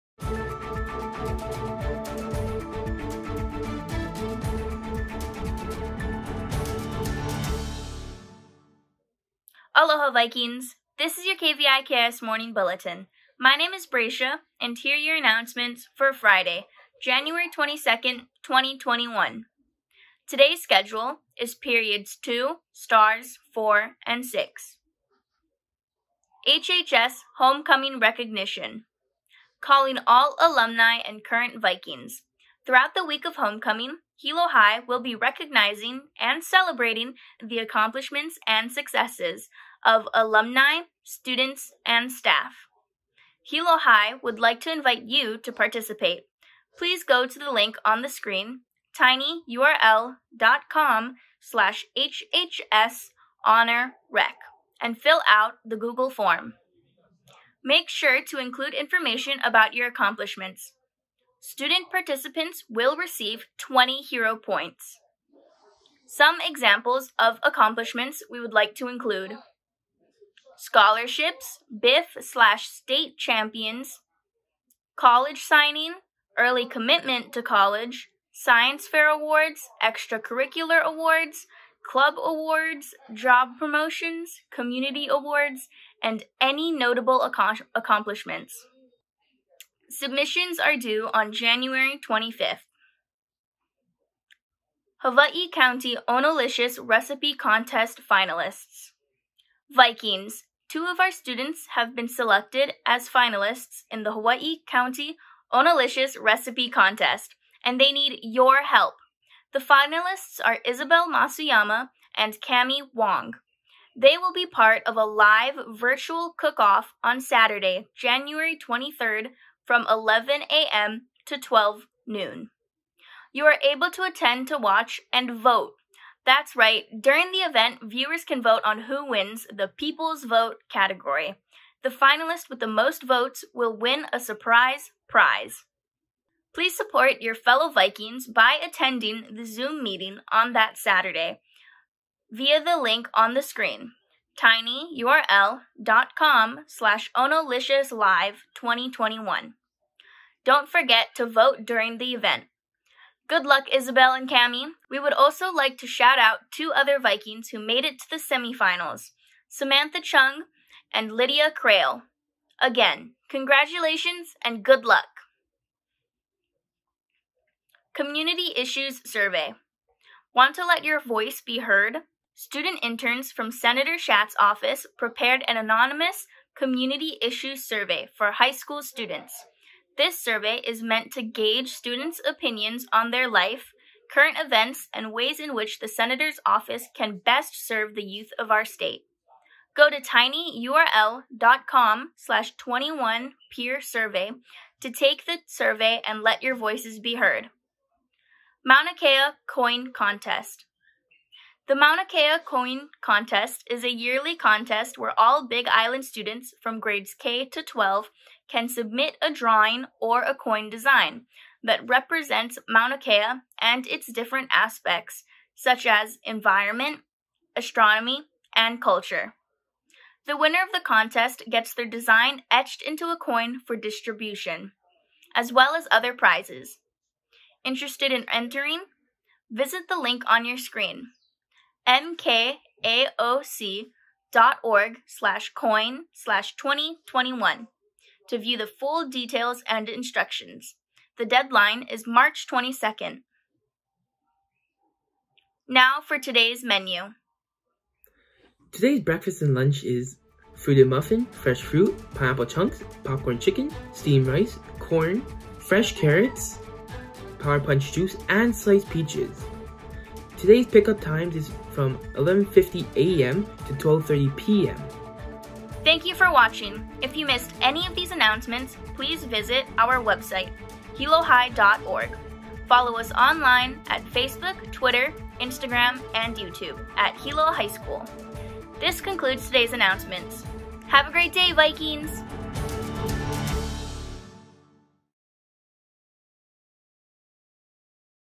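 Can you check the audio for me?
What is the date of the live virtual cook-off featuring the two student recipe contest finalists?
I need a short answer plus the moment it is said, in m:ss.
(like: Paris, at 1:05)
January 23rd, at 1:57.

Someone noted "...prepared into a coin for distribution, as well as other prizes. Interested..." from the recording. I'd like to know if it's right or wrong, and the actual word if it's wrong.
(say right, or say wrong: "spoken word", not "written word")
wrong: "etched", not "prepared".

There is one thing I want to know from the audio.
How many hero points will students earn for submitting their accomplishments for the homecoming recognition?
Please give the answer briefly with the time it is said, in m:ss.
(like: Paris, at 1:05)
20, at 1:03.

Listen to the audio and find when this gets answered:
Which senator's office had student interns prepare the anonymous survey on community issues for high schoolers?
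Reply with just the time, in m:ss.
2:53.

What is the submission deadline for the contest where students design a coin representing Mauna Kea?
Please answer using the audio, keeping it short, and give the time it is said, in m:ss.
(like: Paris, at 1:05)
March 22nd, at 4:02.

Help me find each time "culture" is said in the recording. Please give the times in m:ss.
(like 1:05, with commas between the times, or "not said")
3:38.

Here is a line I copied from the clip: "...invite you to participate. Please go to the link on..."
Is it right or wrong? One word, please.
right.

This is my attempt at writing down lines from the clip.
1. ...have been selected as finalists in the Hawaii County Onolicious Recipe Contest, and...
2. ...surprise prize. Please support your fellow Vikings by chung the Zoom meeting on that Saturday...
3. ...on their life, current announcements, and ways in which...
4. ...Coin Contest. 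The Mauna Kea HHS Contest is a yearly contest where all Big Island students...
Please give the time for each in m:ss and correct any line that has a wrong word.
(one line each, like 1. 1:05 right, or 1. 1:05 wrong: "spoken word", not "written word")
1. 1:41 right
2. 2:14 wrong: "attending", not "chung"
3. 3:02 wrong: "events", not "announcements"
4. 3:19 wrong: "Coin", not "HHS".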